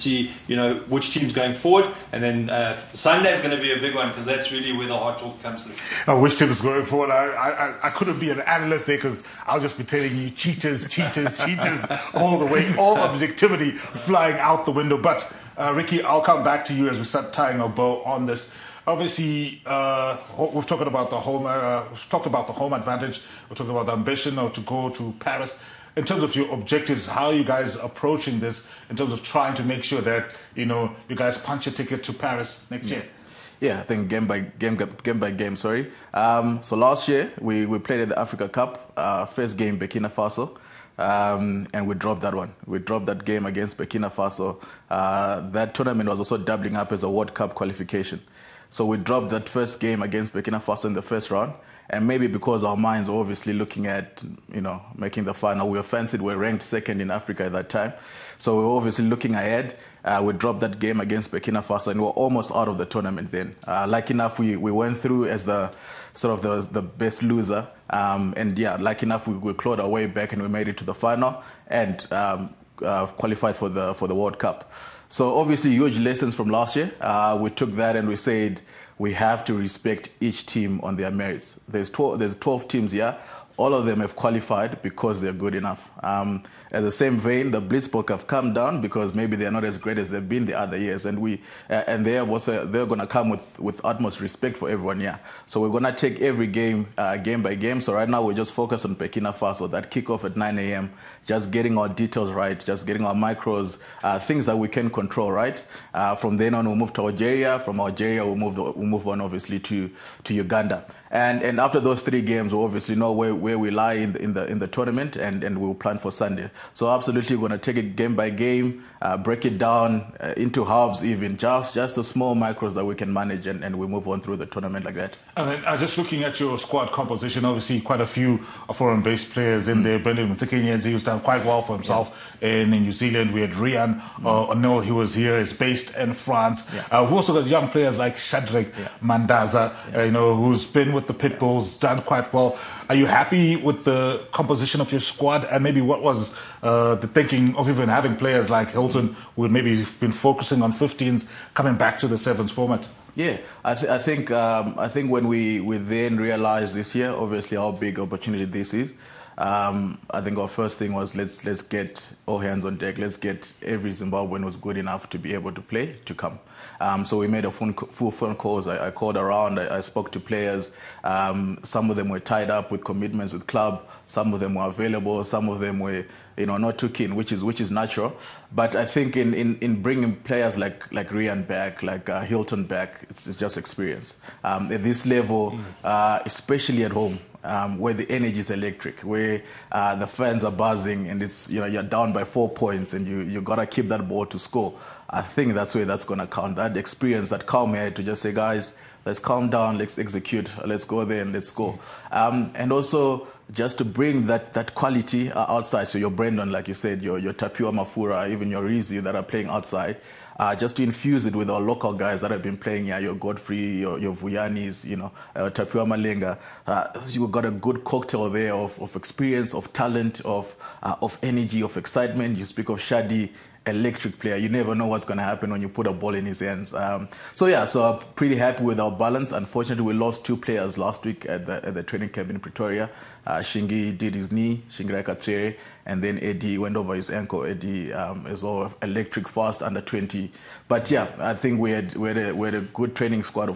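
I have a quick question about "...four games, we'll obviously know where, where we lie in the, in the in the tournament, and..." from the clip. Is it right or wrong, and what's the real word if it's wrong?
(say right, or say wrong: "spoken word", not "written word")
wrong: "three", not "four".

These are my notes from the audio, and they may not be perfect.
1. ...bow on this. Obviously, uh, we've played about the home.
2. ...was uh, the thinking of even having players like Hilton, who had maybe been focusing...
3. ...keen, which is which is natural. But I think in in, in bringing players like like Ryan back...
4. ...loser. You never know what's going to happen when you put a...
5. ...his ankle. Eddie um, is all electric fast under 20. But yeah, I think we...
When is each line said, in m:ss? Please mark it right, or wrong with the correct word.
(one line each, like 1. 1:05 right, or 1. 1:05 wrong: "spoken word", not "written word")
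1. 0:17 wrong: "talked", not "played"
2. 2:26 right
3. 2:56 right
4. 3:44 wrong: "player", not "loser"
5. 3:56 right.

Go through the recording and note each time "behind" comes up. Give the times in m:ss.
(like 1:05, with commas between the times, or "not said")
not said.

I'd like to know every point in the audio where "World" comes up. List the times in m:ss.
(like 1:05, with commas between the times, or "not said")
0:47, 1:14.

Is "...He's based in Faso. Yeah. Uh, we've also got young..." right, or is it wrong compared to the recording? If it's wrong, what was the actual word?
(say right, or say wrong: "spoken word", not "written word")
wrong: "France", not "Faso".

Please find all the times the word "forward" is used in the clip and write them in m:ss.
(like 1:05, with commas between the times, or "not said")
0:01, 0:06.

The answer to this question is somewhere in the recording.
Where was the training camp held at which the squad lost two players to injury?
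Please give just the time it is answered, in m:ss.
3:52.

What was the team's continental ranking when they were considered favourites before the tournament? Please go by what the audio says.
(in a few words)
Second.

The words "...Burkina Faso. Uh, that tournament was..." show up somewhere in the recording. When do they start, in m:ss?
0:43.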